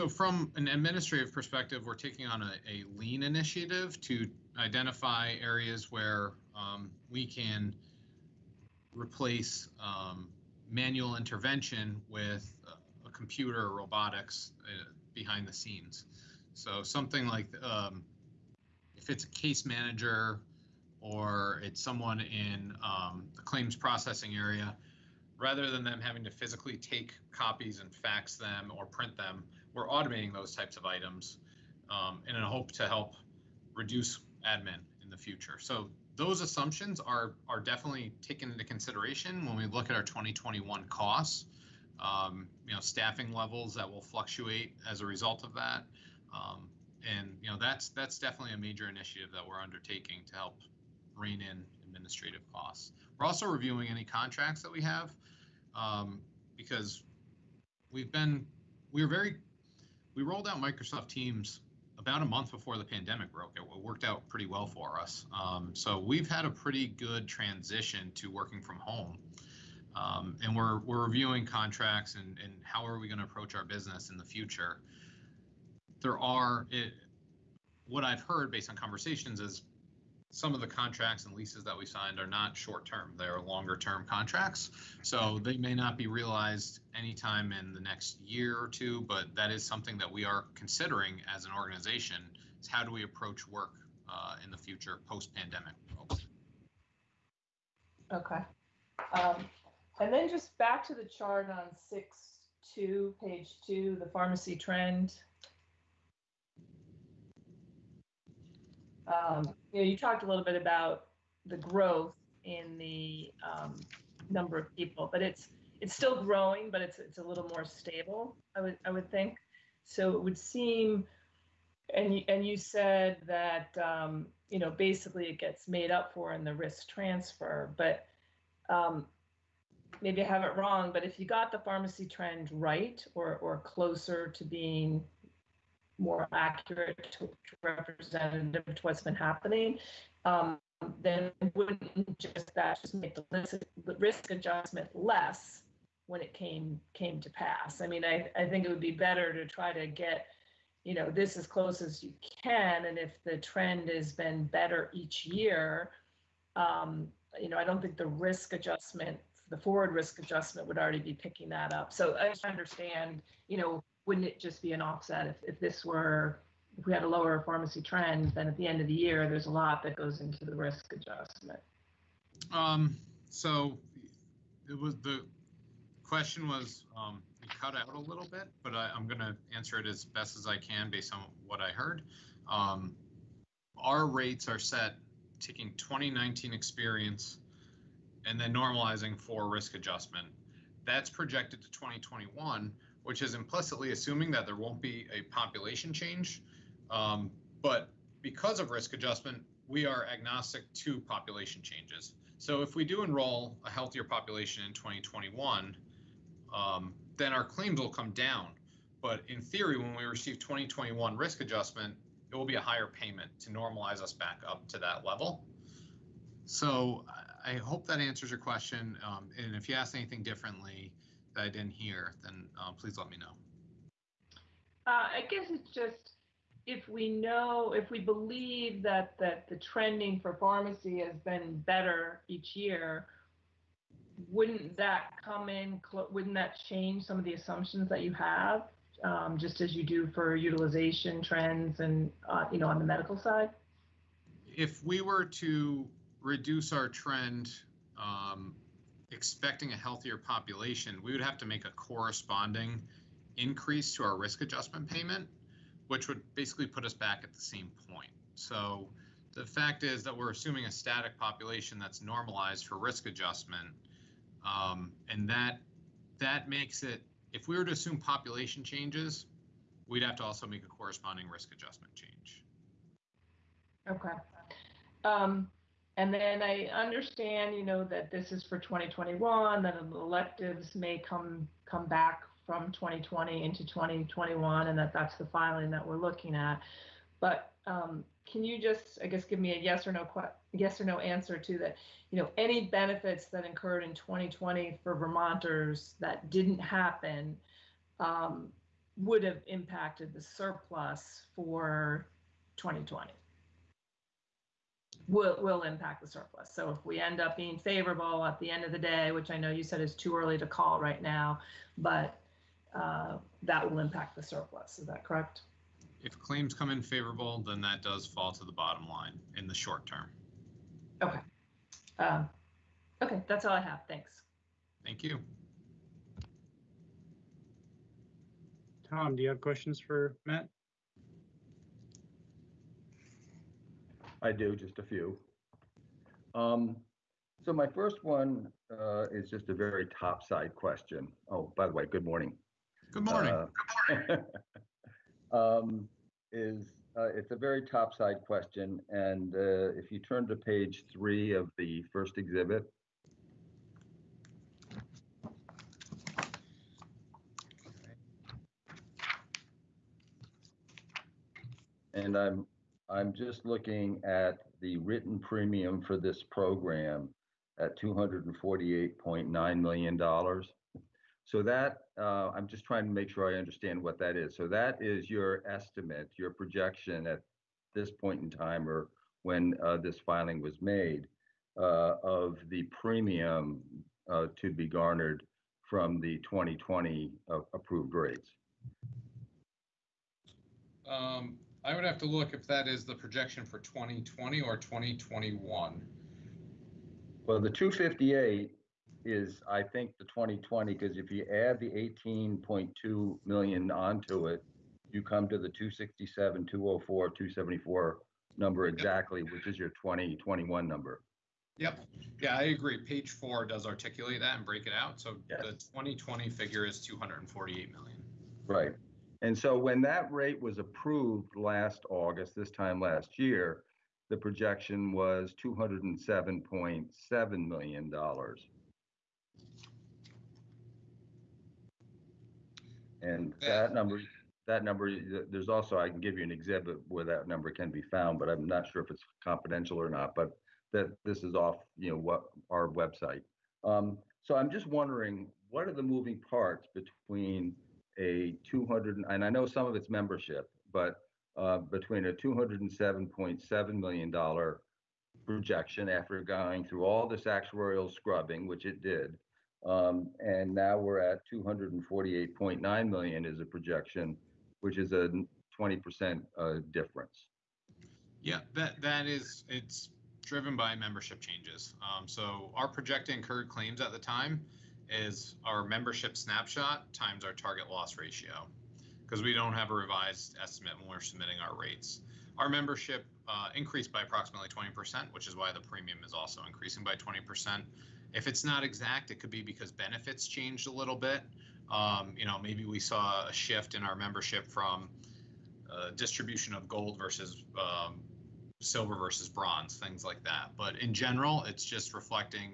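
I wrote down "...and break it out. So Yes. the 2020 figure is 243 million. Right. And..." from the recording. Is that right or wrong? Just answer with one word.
wrong.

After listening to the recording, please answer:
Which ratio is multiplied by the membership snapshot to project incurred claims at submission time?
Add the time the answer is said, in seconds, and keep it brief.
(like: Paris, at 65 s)
target loss ratio, at 477 s.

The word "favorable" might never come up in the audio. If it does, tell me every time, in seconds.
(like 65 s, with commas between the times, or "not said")
307 s, 316 s.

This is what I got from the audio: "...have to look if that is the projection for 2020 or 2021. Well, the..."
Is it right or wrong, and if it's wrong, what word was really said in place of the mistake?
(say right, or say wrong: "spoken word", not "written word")
right.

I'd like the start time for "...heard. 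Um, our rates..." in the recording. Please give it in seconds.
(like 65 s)
181 s.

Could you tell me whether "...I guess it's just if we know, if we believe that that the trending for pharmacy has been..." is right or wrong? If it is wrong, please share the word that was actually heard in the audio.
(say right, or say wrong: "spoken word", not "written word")
right.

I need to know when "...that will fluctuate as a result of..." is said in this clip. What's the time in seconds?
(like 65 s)
43 s.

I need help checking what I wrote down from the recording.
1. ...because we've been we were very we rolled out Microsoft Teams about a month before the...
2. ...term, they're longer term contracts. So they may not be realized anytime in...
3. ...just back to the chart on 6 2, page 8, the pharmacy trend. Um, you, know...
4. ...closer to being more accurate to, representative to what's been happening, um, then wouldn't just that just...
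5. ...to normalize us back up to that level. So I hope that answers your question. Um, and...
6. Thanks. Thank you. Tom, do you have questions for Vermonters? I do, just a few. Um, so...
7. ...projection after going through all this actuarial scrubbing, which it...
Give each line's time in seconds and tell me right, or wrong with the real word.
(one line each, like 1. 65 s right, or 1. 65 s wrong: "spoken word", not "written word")
1. 56 s right
2. 82 s right
3. 100 s wrong: "2", not "8"
4. 133 s right
5. 213 s right
6. 323 s wrong: "Matt", not "Vermonters"
7. 455 s right.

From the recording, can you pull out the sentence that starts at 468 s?
Yeah, that that is it's driven by membership changes.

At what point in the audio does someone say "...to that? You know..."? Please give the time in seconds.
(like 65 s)
291 s.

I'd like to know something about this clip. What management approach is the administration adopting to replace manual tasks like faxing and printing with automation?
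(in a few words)
lean initiative.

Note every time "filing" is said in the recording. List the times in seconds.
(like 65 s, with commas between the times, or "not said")
285 s, 379 s.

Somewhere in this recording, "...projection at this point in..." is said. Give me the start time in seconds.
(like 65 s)
376 s.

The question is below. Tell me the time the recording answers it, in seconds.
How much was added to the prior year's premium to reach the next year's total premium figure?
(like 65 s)
402 s.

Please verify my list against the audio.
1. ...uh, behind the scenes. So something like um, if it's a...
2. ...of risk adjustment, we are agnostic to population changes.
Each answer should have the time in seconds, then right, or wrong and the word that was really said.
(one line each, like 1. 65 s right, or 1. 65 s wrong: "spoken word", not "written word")
1. 14 s right
2. 198 s right.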